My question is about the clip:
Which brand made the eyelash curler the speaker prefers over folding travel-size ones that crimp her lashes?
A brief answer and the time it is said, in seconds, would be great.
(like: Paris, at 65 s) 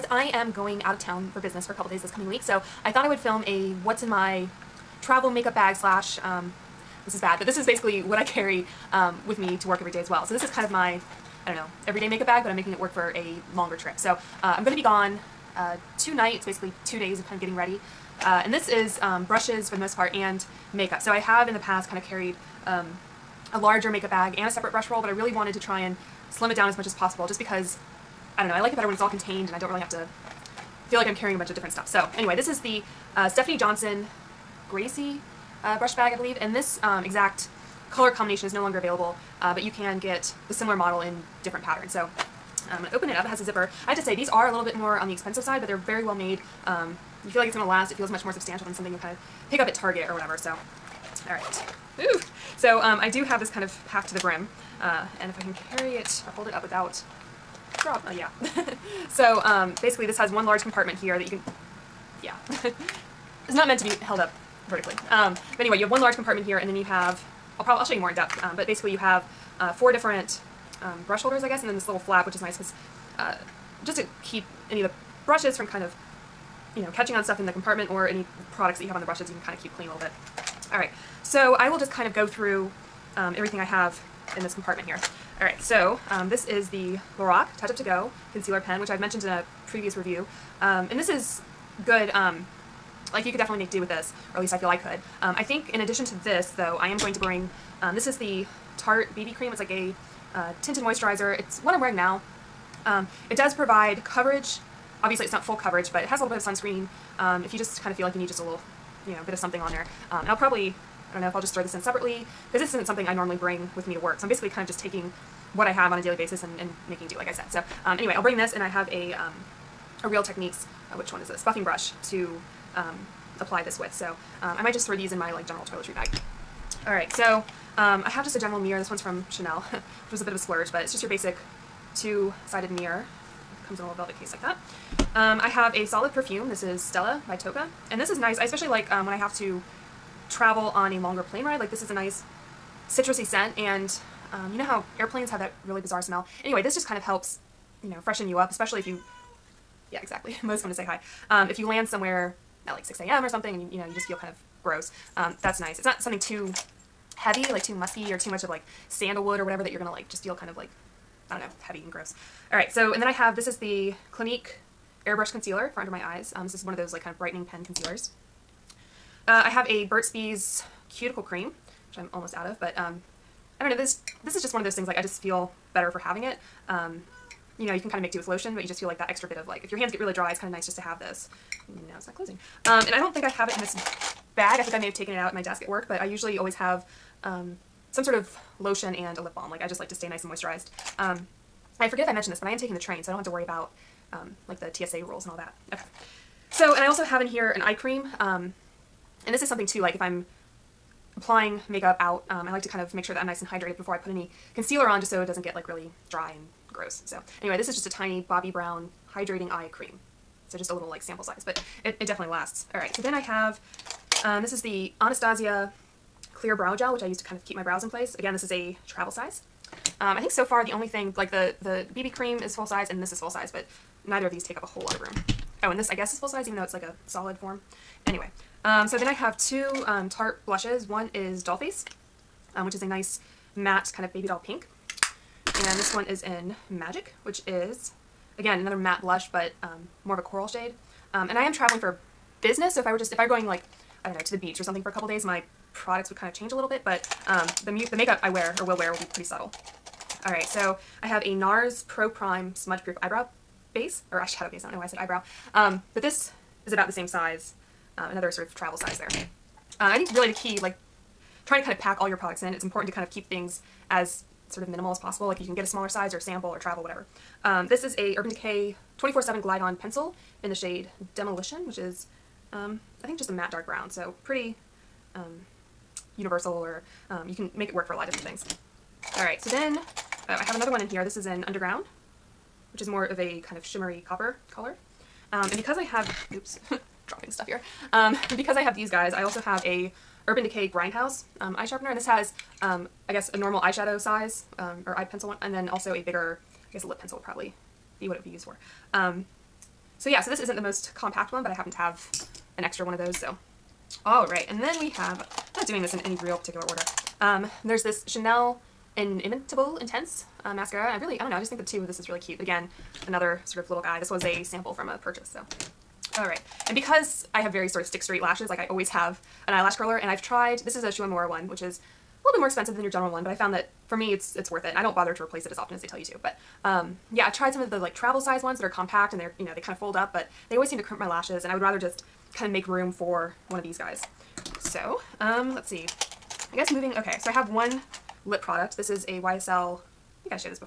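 Shu Uemura, at 320 s.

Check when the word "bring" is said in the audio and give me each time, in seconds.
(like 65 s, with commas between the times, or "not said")
97 s, 113 s, 118 s.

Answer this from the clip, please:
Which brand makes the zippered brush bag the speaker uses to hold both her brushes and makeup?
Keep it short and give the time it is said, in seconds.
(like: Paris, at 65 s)
Stephanie Johnson, at 33 s.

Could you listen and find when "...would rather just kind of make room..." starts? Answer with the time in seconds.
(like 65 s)
331 s.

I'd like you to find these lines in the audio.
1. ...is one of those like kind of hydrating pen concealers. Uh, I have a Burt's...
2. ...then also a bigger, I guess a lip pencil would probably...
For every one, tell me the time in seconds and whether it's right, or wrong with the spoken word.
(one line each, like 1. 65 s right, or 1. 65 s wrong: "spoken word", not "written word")
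1. 166 s wrong: "brightening", not "hydrating"
2. 295 s right.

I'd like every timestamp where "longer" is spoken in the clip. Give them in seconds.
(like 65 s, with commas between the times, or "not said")
13 s, 38 s, 140 s.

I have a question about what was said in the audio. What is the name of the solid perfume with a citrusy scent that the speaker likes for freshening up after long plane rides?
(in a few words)
Stella.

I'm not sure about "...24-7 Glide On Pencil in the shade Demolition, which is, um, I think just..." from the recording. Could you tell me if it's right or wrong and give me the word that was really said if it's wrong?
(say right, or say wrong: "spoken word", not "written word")
right.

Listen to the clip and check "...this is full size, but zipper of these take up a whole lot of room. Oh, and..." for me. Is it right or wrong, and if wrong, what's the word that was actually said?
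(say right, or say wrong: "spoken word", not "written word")
wrong: "neither", not "zipper".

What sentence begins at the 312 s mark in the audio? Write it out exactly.
But again, another sort of little guy.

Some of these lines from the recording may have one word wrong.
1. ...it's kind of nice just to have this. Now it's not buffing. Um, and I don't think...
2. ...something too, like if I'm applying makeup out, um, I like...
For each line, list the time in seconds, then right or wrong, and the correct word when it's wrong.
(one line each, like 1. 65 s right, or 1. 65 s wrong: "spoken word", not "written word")
1. 180 s wrong: "closing", not "buffing"
2. 199 s right.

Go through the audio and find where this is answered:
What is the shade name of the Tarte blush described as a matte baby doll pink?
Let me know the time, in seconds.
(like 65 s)
231 s.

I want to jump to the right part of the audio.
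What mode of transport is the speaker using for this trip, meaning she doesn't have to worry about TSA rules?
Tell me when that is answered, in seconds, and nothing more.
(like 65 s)
192 s.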